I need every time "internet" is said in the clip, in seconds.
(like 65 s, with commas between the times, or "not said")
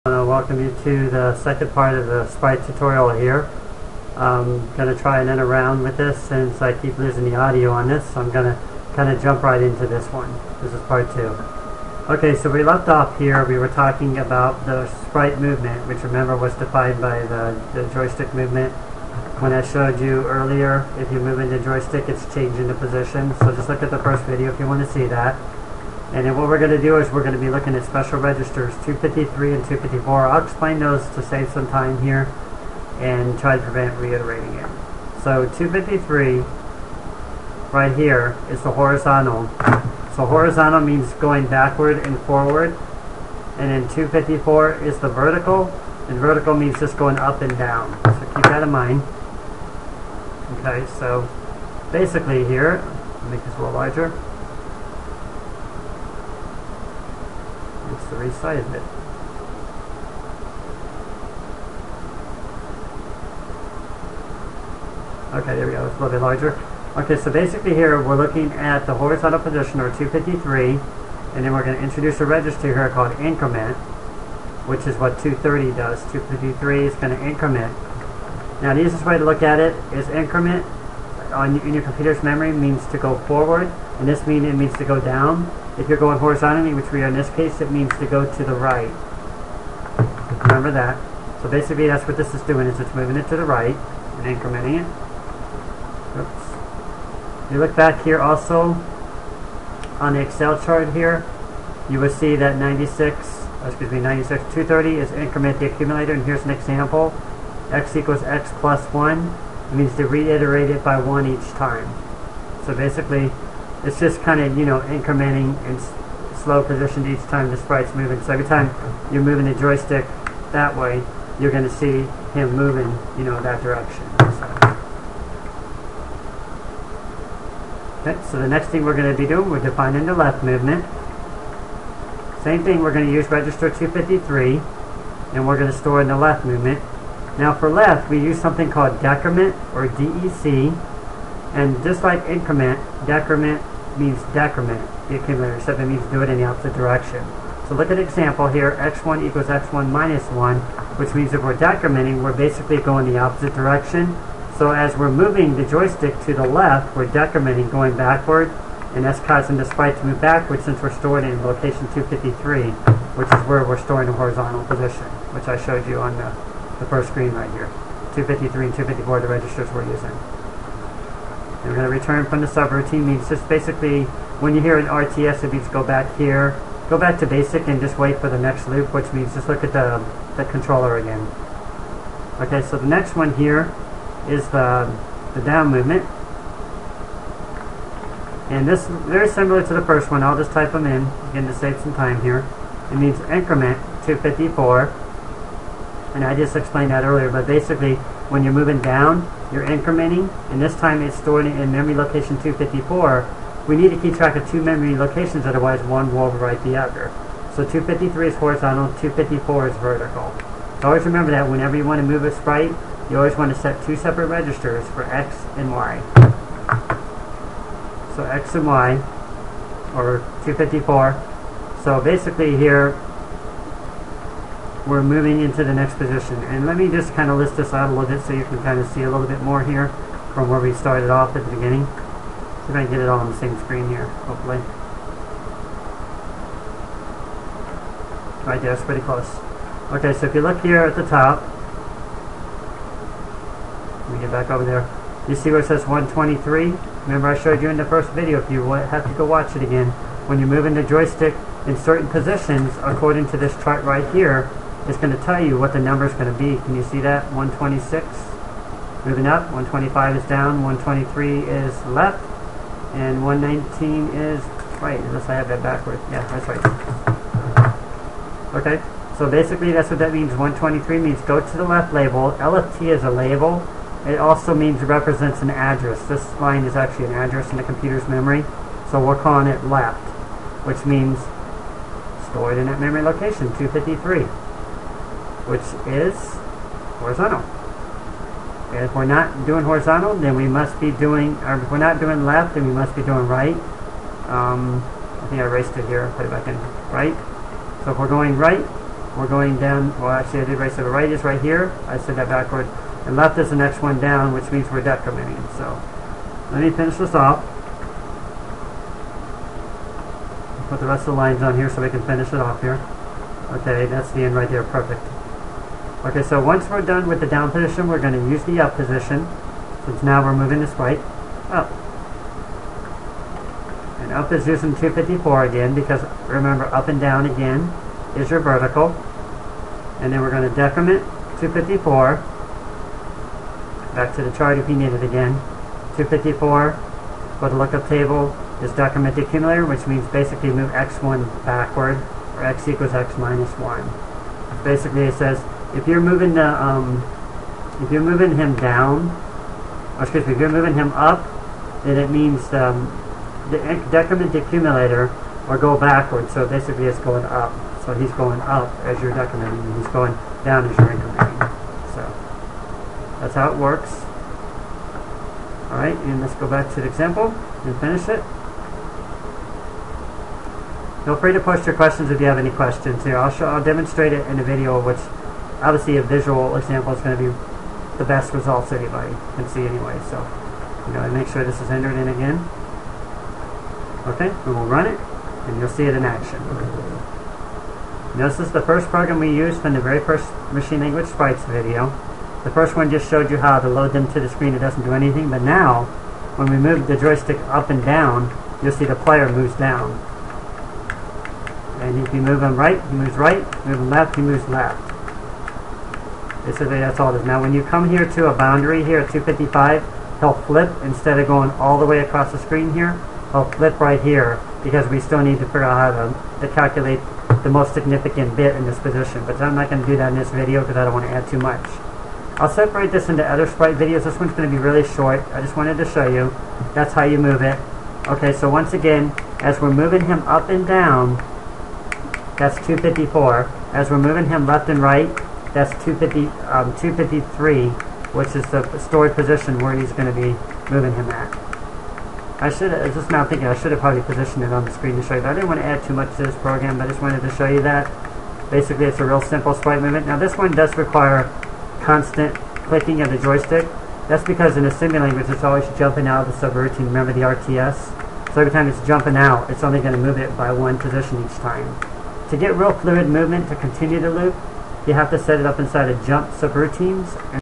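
not said.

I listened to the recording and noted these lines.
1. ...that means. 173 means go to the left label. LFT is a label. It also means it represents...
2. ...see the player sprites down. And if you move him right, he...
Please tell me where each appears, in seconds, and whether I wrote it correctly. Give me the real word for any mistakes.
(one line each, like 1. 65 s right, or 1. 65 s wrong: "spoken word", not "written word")
1. 269 s wrong: "123", not "173"
2. 398 s wrong: "moves", not "sprites".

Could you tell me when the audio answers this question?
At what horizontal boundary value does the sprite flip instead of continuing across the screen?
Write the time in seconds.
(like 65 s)
409 s.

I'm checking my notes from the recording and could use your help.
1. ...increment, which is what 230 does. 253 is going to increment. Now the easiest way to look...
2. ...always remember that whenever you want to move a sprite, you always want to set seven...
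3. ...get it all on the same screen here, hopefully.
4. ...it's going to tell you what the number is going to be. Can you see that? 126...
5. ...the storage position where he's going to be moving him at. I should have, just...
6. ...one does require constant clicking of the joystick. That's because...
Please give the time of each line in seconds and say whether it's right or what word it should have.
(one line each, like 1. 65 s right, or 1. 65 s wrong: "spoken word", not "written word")
1. 73 s right
2. 210 s wrong: "two", not "seven"
3. 232 s right
4. 254 s right
5. 438 s right
6. 450 s right.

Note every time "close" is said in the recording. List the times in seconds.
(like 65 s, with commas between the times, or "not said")
239 s.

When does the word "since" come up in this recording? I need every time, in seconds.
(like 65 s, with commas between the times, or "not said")
6 s, 160 s, 319 s.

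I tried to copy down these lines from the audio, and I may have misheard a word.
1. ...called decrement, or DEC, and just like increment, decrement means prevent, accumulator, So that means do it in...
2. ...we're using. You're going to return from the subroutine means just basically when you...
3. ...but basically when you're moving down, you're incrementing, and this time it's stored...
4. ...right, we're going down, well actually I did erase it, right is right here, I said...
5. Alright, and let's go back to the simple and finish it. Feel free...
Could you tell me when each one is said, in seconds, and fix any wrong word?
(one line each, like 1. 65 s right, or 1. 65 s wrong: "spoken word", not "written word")
1. 138 s wrong: "decrement", not "prevent"
2. 169 s right
3. 197 s right
4. 298 s right
5. 365 s wrong: "example", not "simple".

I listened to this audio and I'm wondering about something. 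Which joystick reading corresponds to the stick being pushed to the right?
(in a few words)
119.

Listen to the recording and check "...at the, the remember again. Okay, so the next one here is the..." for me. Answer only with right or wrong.
wrong.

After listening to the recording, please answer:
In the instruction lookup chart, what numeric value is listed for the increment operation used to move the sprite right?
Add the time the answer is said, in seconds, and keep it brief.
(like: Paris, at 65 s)
230, at 104 s.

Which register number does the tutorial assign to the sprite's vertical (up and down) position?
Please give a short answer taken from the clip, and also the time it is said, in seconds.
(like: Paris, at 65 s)
254, at 43 s.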